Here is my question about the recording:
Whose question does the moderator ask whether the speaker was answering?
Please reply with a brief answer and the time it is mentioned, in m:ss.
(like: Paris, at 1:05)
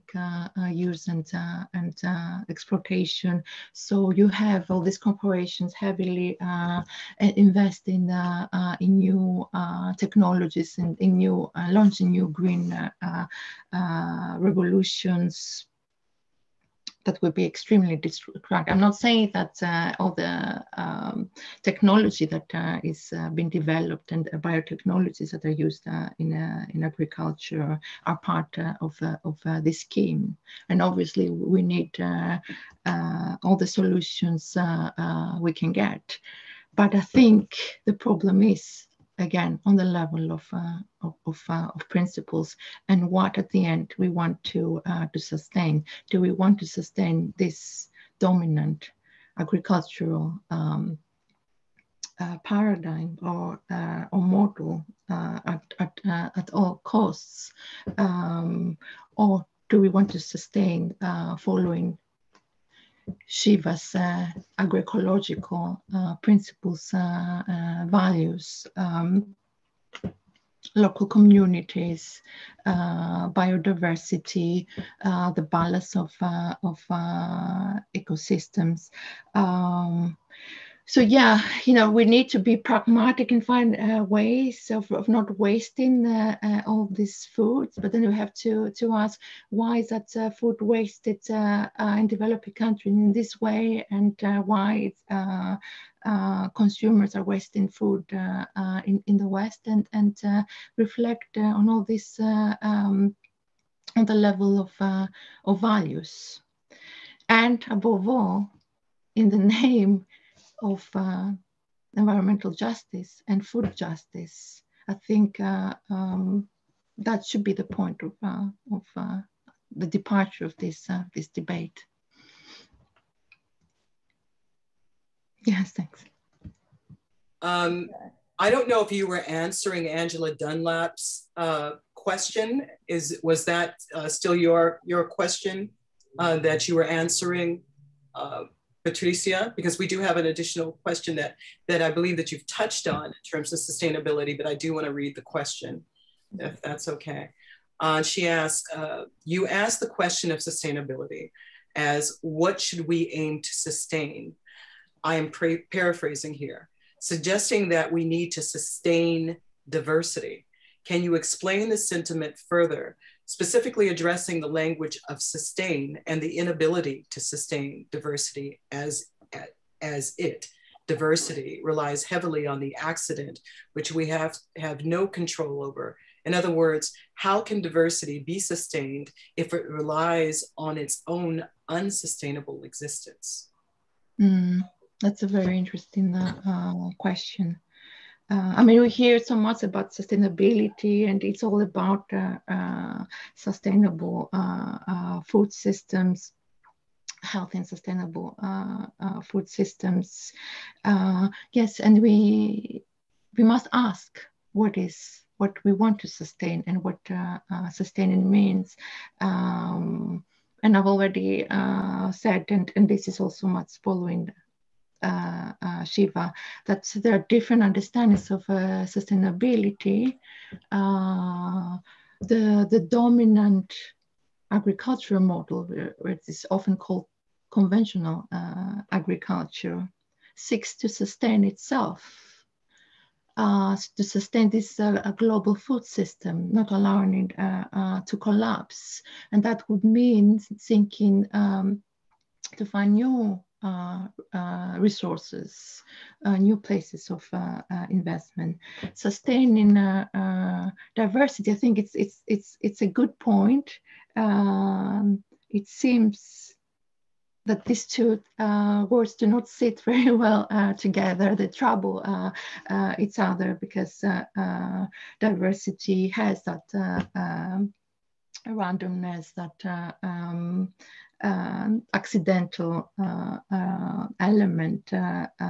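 Angela Dunlap, at 2:09.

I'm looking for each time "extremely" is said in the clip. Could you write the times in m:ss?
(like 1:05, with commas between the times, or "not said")
0:17.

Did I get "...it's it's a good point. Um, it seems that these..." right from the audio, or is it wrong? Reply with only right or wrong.
right.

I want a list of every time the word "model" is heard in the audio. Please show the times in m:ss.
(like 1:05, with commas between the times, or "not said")
0:54, 3:45.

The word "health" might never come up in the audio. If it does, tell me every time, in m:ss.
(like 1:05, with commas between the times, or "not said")
3:17.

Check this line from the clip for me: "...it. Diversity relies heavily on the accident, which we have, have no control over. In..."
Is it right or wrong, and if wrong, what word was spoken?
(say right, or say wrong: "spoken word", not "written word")
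right.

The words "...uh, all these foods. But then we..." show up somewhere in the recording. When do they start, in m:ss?
1:26.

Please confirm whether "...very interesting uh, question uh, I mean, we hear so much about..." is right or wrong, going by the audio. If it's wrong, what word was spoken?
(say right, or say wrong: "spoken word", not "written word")
right.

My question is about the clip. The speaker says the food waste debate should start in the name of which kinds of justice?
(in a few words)
environmental justice.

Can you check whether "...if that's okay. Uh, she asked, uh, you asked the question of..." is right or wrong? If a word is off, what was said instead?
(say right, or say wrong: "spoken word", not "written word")
right.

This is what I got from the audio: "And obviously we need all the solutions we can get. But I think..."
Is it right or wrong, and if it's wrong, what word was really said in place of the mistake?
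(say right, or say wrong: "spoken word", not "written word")
right.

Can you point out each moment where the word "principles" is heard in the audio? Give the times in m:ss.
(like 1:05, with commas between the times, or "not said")
0:41, 1:06.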